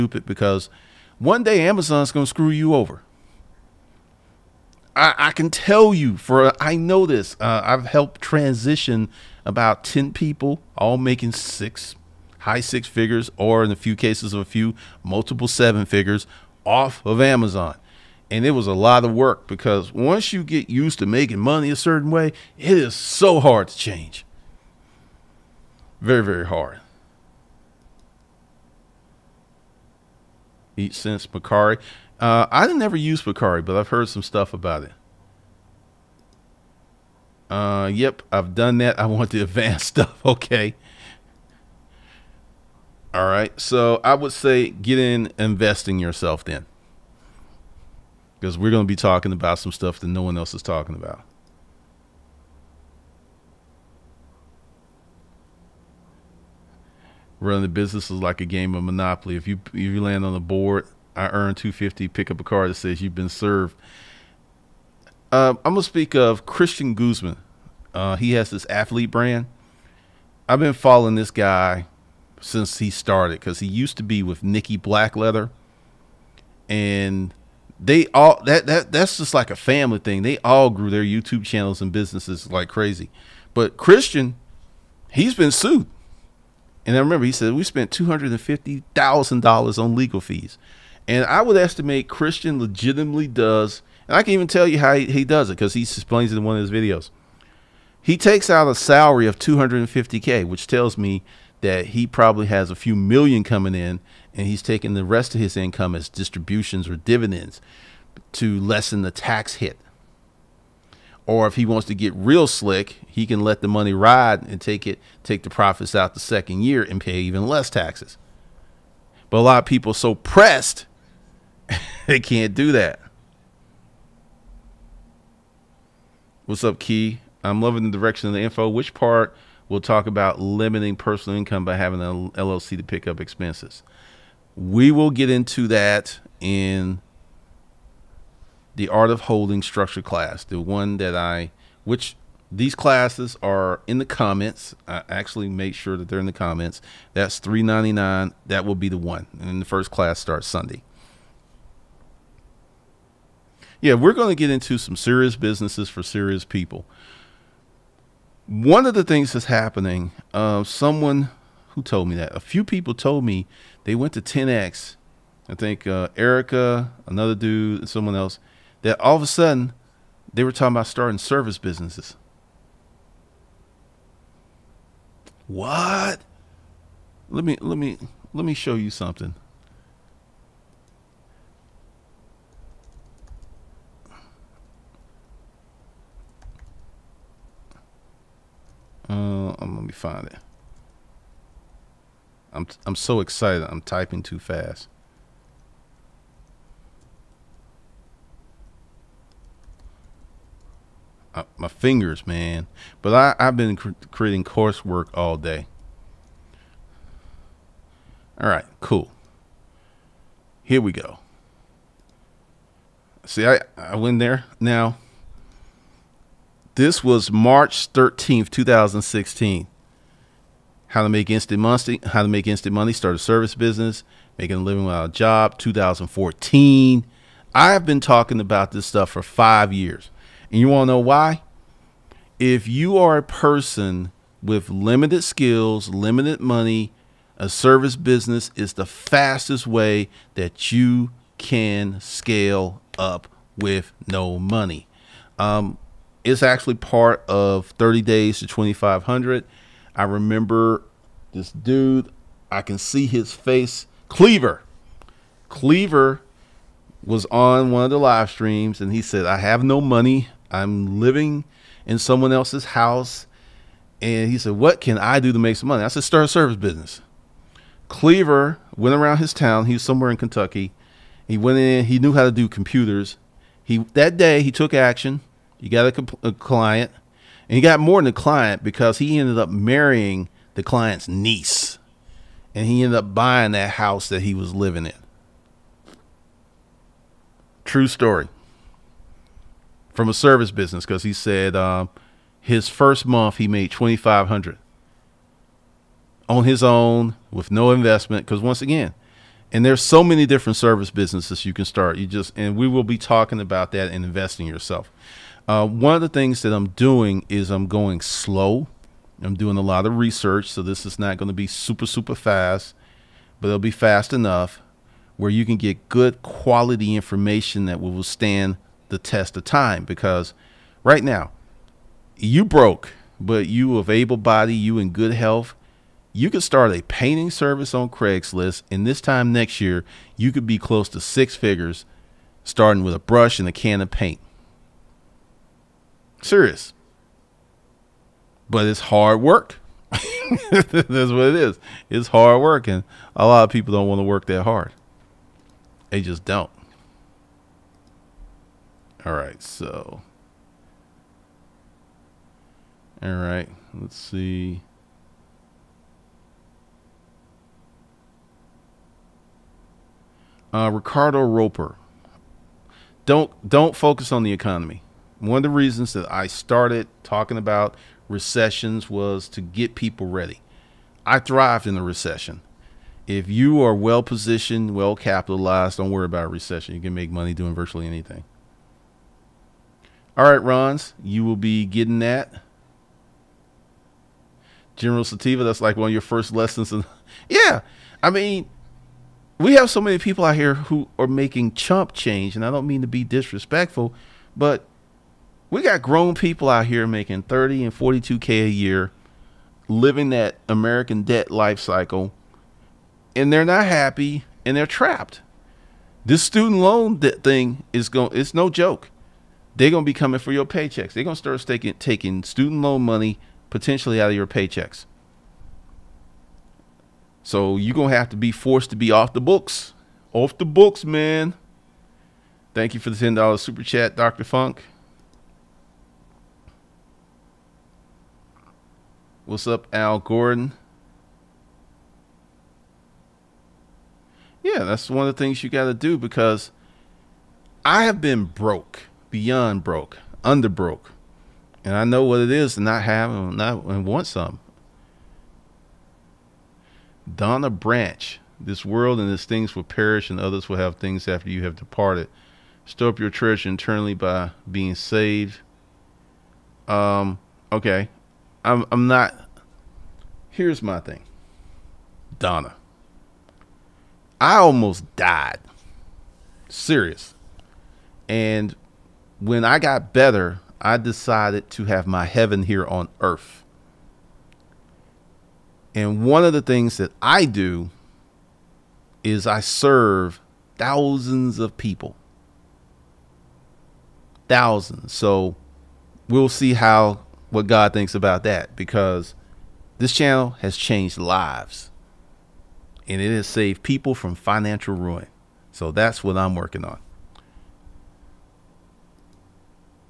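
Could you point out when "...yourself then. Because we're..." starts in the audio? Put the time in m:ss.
0:45.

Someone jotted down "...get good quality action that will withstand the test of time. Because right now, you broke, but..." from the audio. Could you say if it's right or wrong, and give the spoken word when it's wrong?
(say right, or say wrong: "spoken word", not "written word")
wrong: "information", not "action".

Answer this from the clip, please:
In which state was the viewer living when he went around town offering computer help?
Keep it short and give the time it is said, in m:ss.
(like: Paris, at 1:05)
Kentucky, at 4:30.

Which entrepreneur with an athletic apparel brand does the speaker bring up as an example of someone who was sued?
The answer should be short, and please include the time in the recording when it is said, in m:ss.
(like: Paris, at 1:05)
Christian Guzman, at 1:06.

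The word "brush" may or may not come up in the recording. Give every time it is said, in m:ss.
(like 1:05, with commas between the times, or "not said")
5:32.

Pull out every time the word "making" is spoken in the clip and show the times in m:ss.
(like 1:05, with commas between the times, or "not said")
0:10, 0:21, 3:44, 6:31, 6:36.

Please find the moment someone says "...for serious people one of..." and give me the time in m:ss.
2:35.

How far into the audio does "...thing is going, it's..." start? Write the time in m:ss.
6:46.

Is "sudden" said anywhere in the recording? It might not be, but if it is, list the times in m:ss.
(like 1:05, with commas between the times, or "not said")
2:49.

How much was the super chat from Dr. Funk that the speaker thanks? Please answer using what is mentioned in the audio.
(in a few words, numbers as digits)
$10.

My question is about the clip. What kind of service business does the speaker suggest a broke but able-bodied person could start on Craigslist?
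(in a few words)
Painting service.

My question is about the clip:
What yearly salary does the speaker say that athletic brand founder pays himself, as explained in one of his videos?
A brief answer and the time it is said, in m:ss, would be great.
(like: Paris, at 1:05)
$250k, at 1:39.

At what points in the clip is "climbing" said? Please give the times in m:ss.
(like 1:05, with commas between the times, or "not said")
not said.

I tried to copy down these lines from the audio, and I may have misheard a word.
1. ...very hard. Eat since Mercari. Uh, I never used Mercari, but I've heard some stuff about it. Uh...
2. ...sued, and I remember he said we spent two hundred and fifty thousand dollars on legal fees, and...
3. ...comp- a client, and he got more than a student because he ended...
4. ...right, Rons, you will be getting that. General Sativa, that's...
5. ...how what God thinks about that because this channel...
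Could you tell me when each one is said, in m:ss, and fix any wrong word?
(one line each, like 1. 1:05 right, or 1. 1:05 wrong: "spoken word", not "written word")
1. 0:26 right
2. 1:25 right
3. 4:35 wrong: "client", not "student"
4. 6:20 right
5. 8:06 right.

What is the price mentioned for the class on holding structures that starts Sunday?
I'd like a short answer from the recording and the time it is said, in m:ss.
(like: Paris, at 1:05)
$399, at 2:27.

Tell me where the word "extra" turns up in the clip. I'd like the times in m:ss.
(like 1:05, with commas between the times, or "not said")
not said.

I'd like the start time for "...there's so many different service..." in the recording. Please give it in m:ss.
4:59.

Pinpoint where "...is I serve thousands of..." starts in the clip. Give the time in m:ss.
7:59.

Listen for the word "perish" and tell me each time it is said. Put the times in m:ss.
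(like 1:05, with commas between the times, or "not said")
7:29.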